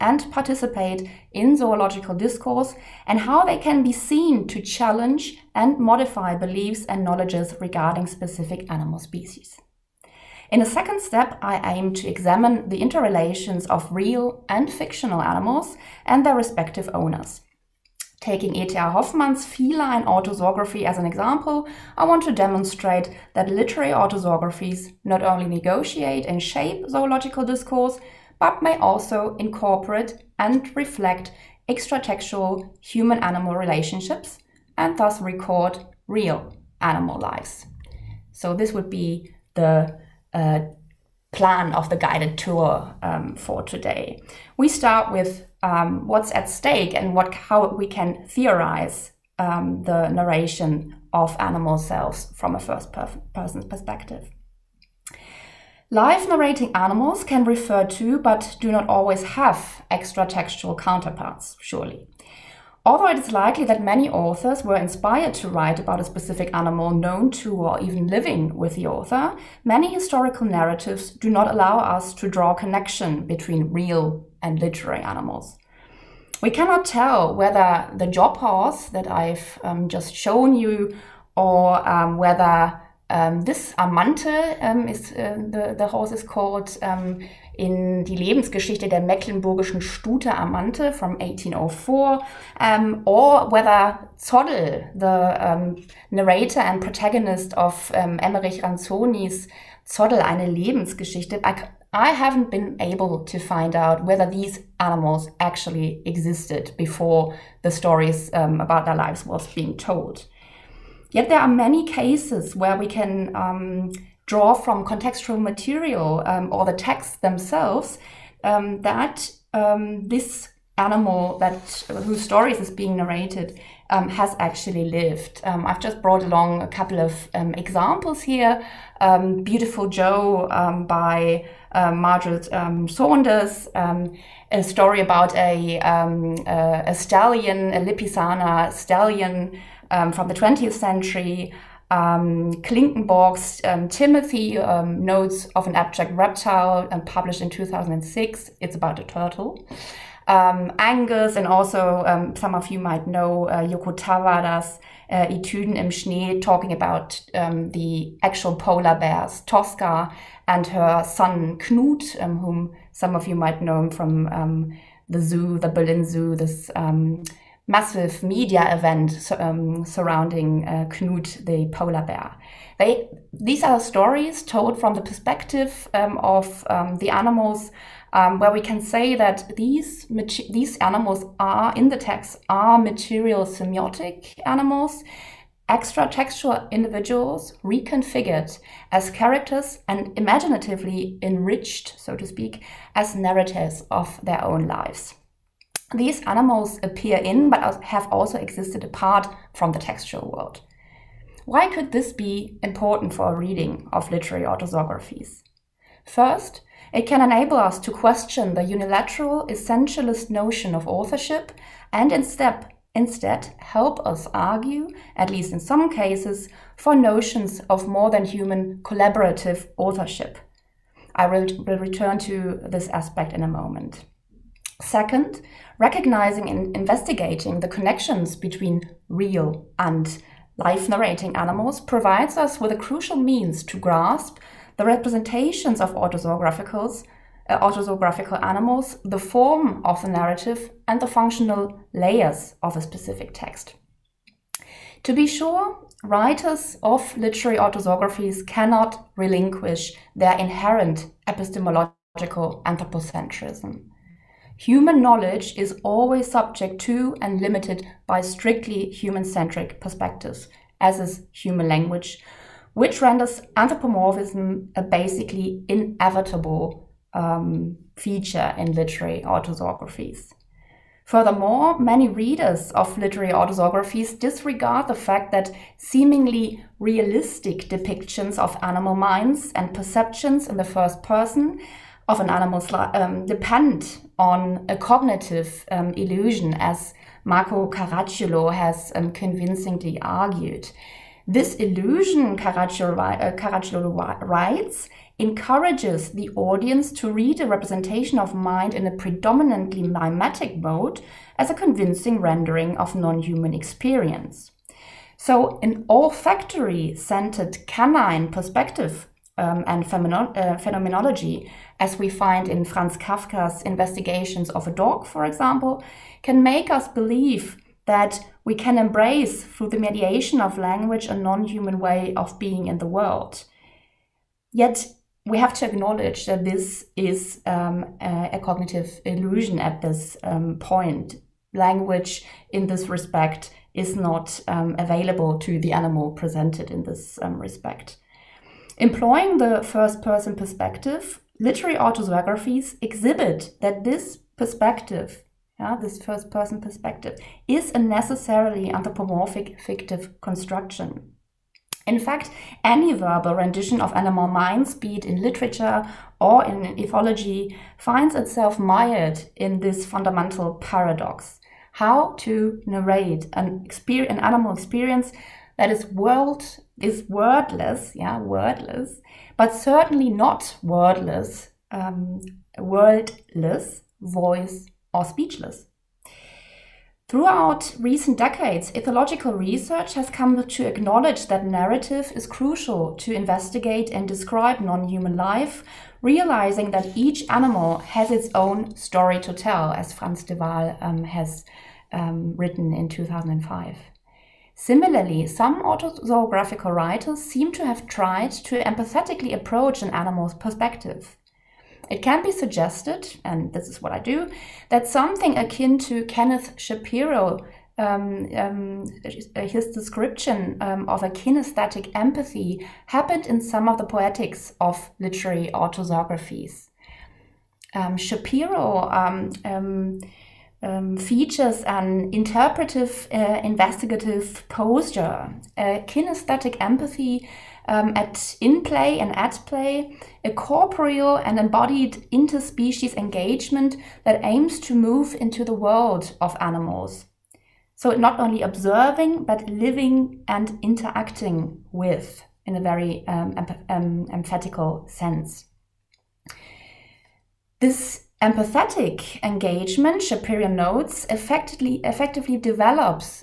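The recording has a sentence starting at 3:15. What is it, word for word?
These animals appear in, but have also existed apart from the textual world.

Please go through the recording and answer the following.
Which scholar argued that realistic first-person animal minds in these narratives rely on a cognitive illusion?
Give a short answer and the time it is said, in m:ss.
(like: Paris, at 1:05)
Marco Caracciolo, at 4:47.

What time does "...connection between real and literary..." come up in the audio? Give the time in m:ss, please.
1:12.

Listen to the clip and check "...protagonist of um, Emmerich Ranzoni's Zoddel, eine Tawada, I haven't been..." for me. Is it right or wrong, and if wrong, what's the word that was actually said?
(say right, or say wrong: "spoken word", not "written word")
wrong: "Lebensgeschichte", not "Tawada".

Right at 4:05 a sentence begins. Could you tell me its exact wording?
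To be sure, writers of literary autographies cannot relinquish their inherent epistemological anthropocentrism.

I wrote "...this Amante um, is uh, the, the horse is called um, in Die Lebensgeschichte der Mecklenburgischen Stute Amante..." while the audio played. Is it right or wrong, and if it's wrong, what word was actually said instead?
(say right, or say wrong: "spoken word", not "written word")
right.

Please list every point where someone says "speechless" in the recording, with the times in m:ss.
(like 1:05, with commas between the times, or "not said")
6:15.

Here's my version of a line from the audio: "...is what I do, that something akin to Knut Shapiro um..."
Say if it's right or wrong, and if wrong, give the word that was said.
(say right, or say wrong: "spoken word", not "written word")
wrong: "Kenneth", not "Knut".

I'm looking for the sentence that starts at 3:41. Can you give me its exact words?
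I will, will return to this aspect in a moment.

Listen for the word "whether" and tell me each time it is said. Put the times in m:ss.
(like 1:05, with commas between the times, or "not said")
1:17, 1:22, 1:33, 1:44.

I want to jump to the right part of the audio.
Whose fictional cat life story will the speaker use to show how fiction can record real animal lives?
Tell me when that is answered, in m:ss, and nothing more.
0:18.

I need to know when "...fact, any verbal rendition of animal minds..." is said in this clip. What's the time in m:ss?
5:51.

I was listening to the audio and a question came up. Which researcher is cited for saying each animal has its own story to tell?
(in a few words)
Frans de Waal.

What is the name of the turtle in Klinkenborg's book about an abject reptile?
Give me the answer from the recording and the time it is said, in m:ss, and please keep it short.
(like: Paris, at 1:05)
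Angus, at 2:30.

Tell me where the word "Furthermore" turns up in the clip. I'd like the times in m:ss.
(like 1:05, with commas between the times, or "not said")
4:31.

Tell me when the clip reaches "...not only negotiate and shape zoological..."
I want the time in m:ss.
0:25.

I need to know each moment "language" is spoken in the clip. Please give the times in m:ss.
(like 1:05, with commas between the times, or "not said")
4:21, 5:20, 5:31.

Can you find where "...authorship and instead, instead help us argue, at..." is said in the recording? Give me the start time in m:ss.
3:30.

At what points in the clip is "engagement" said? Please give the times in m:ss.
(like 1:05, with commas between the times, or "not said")
7:12, 7:29.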